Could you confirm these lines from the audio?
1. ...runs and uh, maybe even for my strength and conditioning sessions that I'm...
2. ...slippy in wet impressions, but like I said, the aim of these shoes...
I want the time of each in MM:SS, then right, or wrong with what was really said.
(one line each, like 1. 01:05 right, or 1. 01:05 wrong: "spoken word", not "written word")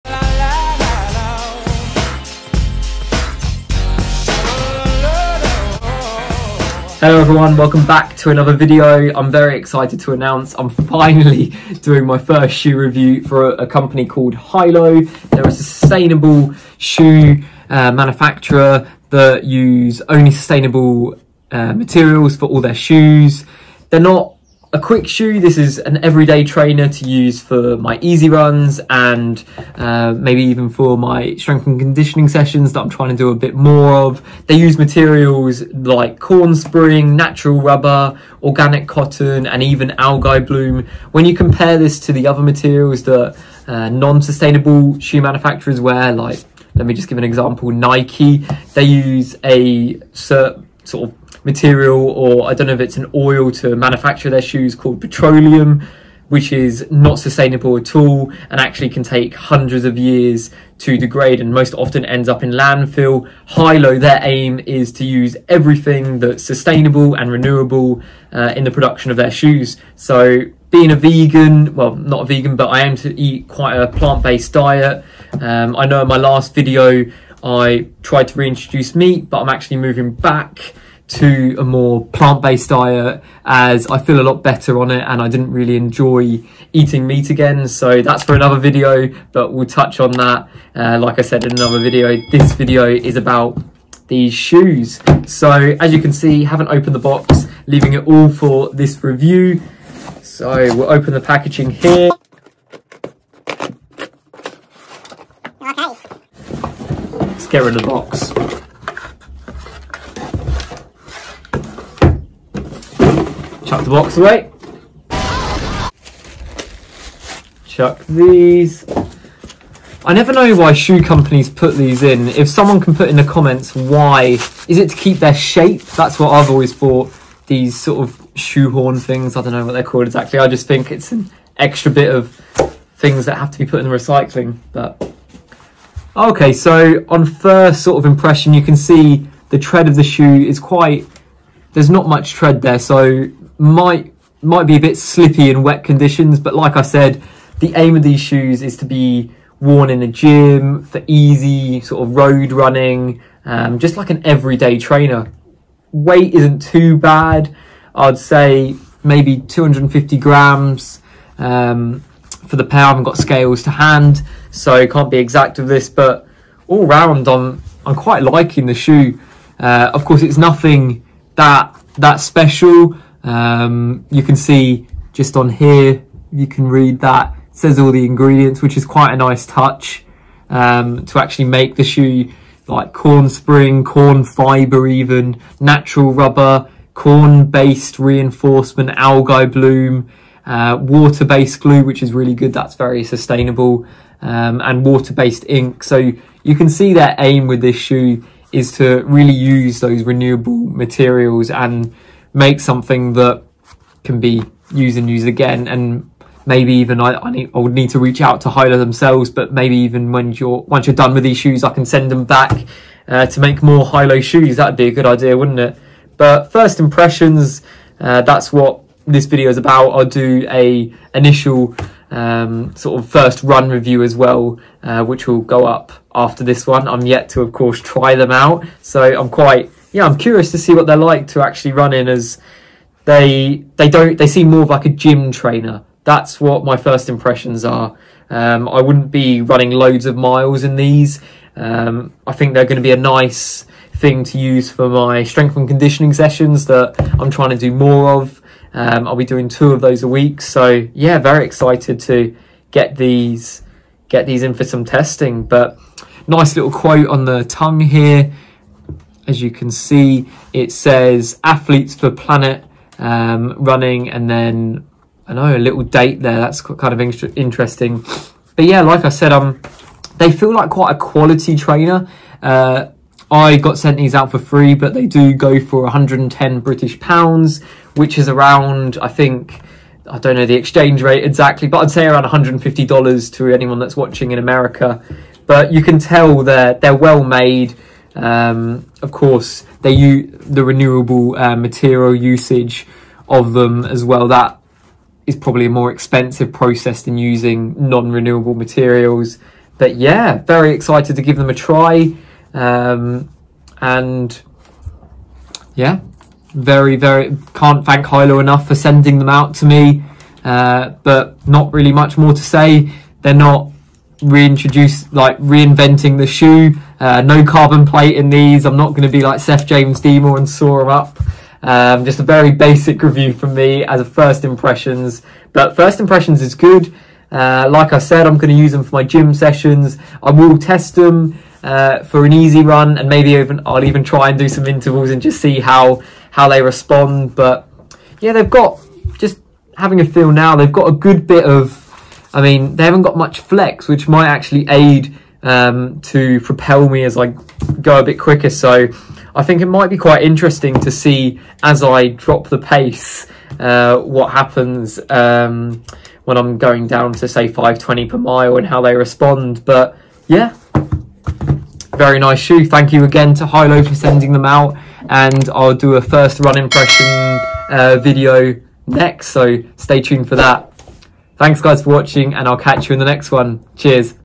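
1. 00:28 right
2. 02:24 wrong: "conditions", not "impressions".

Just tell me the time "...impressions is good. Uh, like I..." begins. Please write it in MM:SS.
05:25.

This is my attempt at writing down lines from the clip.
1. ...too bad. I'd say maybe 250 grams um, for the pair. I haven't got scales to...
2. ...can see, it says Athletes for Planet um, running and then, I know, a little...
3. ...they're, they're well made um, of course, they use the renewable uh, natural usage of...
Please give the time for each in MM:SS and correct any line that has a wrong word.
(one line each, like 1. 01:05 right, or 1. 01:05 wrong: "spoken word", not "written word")
1. 02:36 right
2. 04:19 right
3. 04:46 wrong: "material", not "natural".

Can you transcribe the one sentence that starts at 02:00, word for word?
I never know why shoe companies put these in.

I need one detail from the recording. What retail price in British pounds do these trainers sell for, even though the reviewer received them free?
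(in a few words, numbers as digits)
110 pounds.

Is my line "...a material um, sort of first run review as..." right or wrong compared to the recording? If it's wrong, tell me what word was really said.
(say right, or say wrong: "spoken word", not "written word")
wrong: "initial", not "material".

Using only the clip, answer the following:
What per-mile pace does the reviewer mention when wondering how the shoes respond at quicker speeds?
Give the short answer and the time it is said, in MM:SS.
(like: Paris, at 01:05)
5:20 per mile, at 05:57.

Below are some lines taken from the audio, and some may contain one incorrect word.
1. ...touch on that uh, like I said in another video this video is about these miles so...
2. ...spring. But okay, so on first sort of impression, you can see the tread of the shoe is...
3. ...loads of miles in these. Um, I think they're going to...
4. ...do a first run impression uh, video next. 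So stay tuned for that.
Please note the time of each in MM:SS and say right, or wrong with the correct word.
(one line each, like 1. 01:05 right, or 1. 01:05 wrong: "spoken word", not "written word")
1. 01:29 wrong: "shoes", not "miles"
2. 02:13 wrong: "recycling", not "spring"
3. 03:59 right
4. 06:05 right.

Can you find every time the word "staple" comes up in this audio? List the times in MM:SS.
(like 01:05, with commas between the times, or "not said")
not said.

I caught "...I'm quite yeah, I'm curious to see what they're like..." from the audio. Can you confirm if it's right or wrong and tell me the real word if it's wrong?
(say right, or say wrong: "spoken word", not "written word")
right.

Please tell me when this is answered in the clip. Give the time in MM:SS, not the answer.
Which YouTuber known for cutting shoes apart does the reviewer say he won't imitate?
05:19.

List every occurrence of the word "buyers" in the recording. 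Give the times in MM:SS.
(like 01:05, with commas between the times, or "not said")
not said.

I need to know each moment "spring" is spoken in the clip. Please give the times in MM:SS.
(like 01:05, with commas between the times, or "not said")
00:36, 03:03.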